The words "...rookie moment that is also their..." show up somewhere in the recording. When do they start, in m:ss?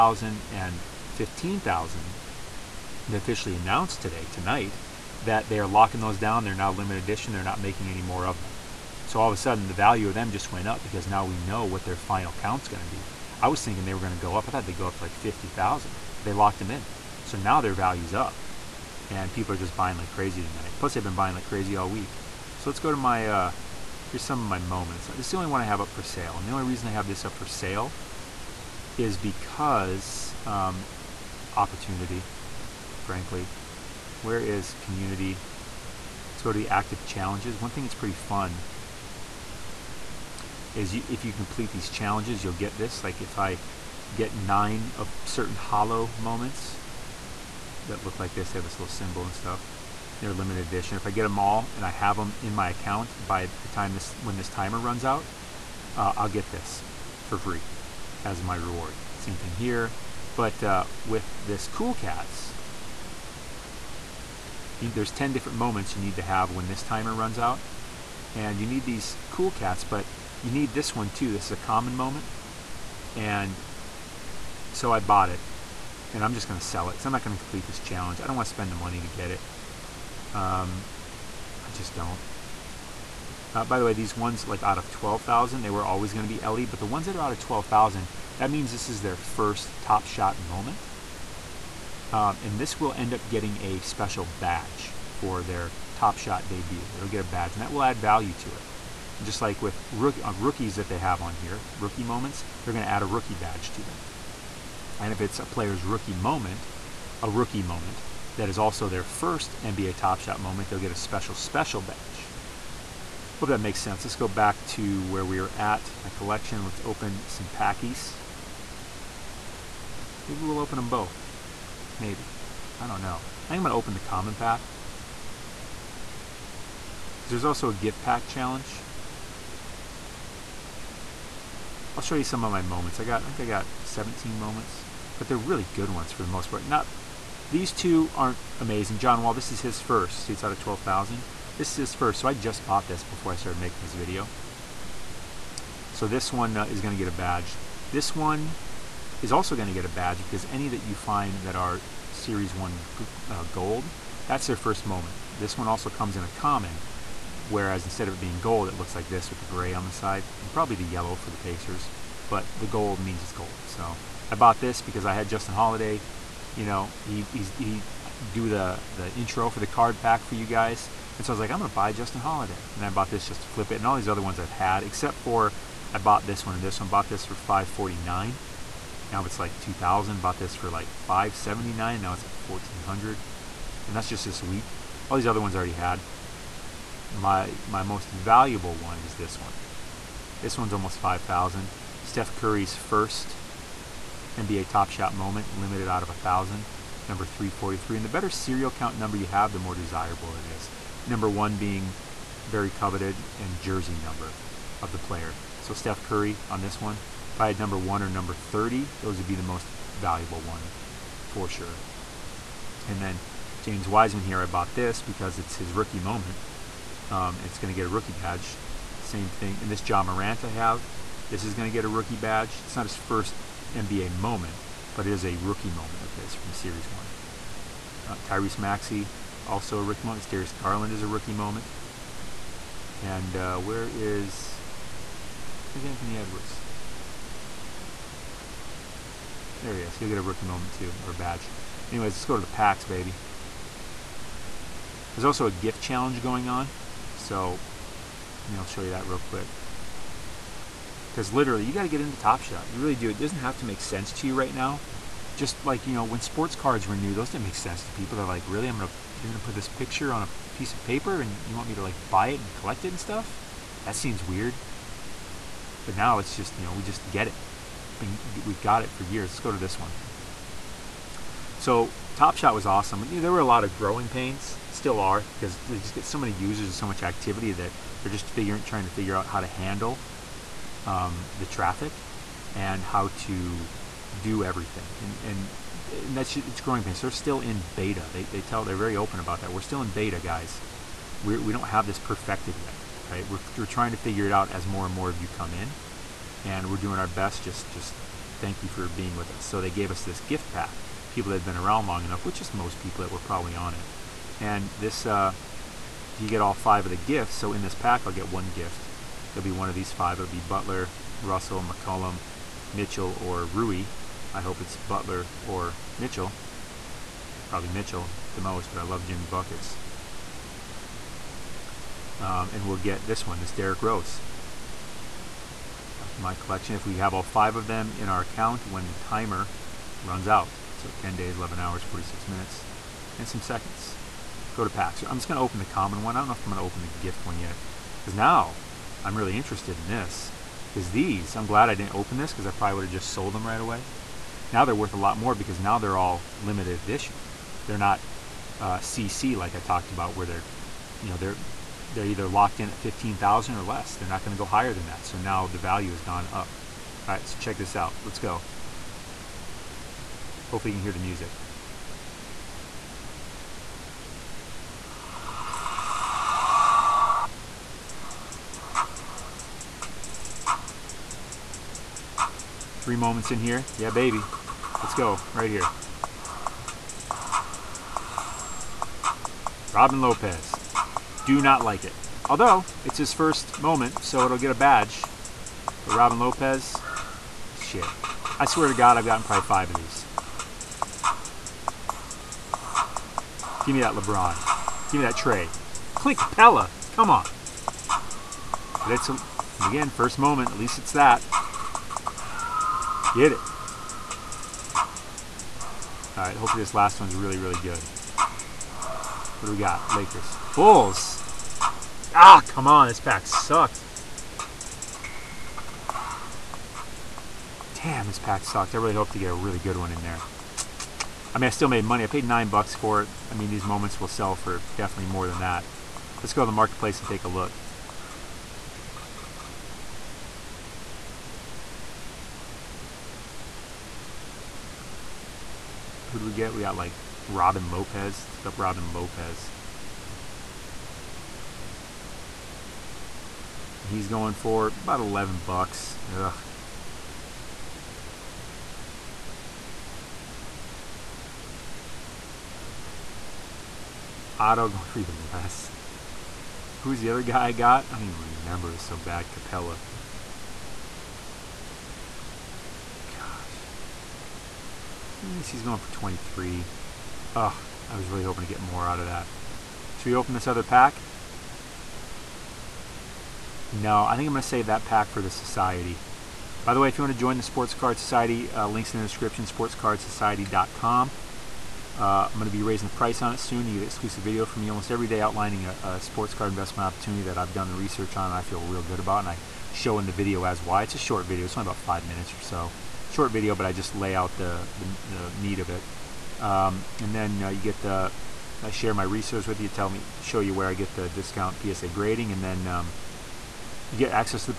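1:47.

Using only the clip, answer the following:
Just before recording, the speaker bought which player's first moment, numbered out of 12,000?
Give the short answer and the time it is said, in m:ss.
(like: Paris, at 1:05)
John Wall, at 2:18.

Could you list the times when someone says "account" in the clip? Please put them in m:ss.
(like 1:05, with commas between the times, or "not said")
0:52, 5:28.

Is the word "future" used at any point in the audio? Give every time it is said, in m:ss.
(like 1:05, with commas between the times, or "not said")
not said.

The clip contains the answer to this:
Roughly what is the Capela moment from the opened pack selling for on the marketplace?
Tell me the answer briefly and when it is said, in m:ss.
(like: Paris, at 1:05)
23, at 7:45.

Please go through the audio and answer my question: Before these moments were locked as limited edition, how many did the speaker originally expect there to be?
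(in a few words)
50,000.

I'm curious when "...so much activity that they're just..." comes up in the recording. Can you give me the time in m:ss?
4:36.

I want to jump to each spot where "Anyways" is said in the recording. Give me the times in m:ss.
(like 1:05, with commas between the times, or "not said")
4:01.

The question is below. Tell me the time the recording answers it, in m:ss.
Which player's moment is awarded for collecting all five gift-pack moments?
5:23.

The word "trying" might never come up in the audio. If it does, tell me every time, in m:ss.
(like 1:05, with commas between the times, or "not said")
4:38, 4:53.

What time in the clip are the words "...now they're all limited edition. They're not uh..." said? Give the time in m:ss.
5:45.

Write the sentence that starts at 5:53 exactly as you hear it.
They're not going to go higher than that.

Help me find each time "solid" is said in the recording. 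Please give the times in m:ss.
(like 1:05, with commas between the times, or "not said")
not said.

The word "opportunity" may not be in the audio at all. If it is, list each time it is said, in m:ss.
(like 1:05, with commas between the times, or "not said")
0:31, 8:06.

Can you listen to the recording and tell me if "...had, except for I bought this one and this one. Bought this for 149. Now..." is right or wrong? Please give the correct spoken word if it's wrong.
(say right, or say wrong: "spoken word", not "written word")
wrong: "549", not "149".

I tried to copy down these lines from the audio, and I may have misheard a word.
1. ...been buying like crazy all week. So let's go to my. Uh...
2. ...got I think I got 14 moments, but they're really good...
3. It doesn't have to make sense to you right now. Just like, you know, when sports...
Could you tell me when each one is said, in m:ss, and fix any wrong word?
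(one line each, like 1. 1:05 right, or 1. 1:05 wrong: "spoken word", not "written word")
1. 0:21 right
2. 2:13 wrong: "17", not "14"
3. 4:13 right.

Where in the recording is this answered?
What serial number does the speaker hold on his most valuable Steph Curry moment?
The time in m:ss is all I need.
3:17.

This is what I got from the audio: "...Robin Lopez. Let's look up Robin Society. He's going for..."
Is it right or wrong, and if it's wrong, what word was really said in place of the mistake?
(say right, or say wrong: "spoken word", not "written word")
wrong: "Lopez", not "Society".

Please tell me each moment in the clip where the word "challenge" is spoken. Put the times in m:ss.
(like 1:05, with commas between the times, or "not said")
0:37, 0:41, 1:17, 2:08, 4:05.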